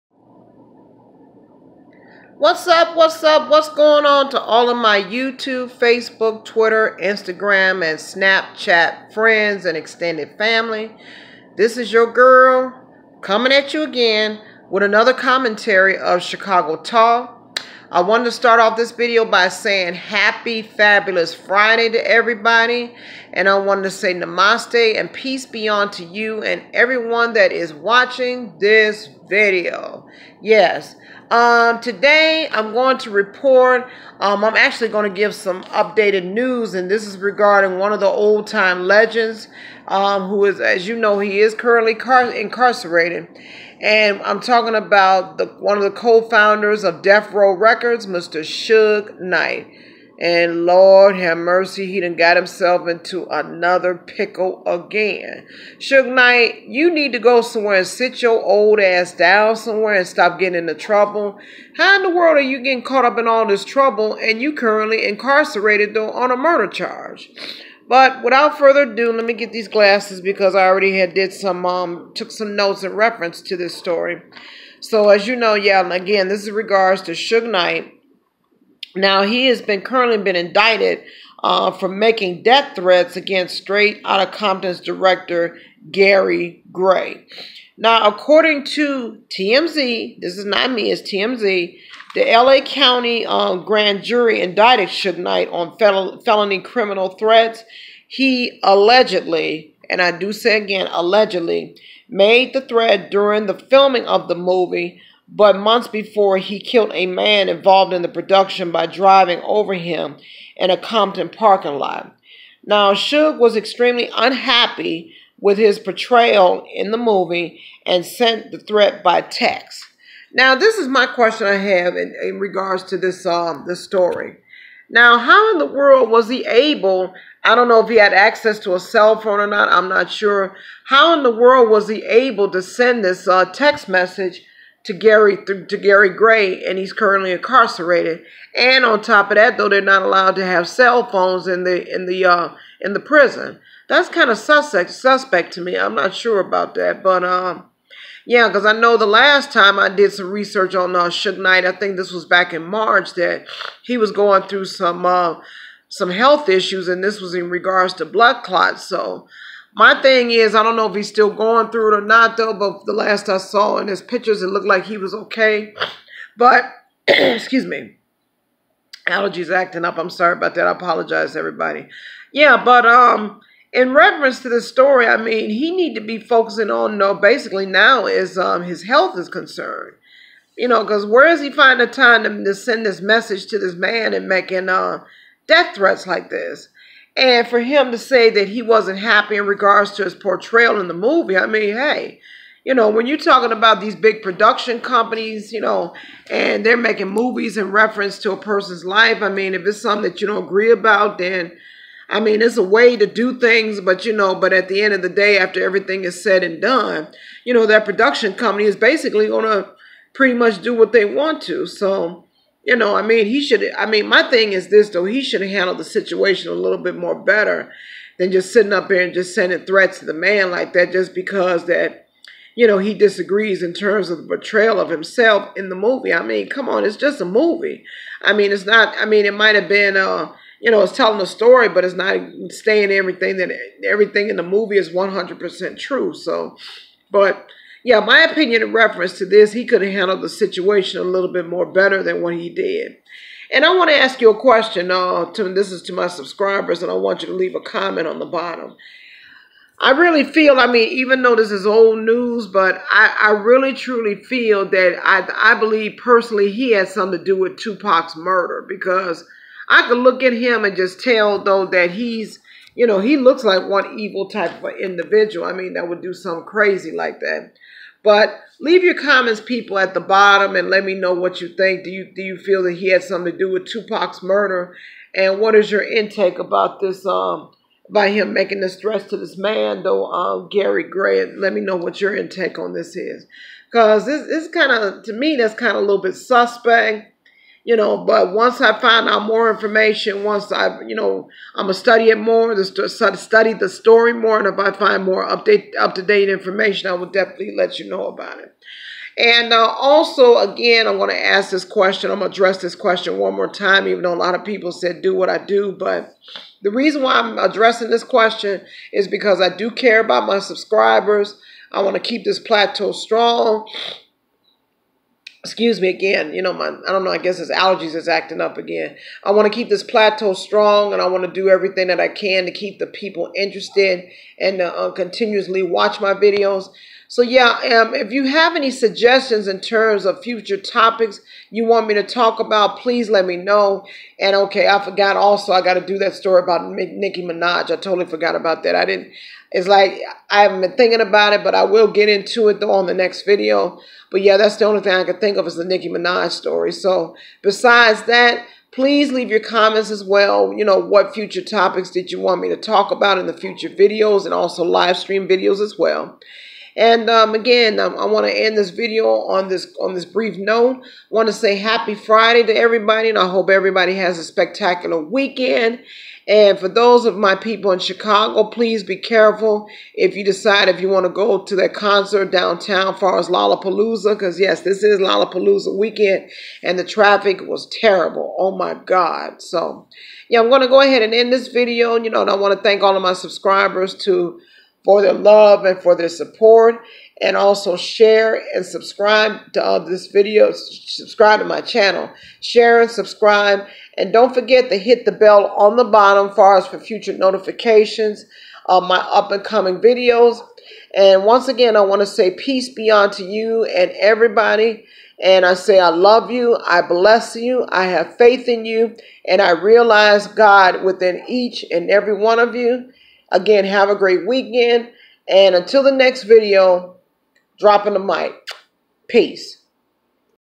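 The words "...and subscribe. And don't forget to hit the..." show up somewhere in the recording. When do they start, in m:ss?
6:32.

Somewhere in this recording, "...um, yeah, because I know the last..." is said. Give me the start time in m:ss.
2:27.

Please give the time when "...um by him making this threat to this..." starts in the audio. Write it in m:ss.
4:37.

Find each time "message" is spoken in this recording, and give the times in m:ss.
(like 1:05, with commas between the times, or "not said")
2:13, 3:02.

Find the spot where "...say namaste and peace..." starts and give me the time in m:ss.
0:23.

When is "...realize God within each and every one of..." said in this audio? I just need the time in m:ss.
6:49.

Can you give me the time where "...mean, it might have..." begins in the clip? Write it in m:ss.
3:49.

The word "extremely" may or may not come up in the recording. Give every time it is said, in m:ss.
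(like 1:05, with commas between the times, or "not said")
1:53.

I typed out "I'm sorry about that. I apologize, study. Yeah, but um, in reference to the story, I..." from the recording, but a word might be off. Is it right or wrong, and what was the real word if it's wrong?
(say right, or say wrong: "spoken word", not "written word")
wrong: "everybody", not "study".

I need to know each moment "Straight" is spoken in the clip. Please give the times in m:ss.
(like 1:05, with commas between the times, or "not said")
1:23.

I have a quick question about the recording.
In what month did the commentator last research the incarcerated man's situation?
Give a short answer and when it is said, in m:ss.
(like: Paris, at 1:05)
March, at 2:32.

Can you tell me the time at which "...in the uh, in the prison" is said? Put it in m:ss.
2:21.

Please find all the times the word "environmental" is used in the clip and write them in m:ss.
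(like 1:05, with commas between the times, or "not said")
not said.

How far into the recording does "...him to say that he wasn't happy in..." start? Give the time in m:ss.
3:07.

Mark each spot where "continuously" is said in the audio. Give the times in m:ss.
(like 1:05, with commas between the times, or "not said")
5:24.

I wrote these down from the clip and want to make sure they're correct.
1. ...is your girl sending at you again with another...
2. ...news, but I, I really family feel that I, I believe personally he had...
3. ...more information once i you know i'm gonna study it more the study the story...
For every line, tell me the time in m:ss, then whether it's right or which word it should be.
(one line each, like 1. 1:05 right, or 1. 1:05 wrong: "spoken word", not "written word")
1. 0:11 wrong: "coming", not "sending"
2. 4:12 wrong: "truly", not "family"
3. 4:49 right.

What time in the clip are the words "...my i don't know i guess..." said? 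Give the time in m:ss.
5:16.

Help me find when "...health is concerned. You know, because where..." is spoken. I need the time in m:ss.
2:58.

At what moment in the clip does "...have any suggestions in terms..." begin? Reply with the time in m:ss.
5:28.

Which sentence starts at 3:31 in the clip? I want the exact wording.
So, you know, I mean, he should.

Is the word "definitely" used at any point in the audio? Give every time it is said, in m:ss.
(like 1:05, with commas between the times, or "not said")
4:57.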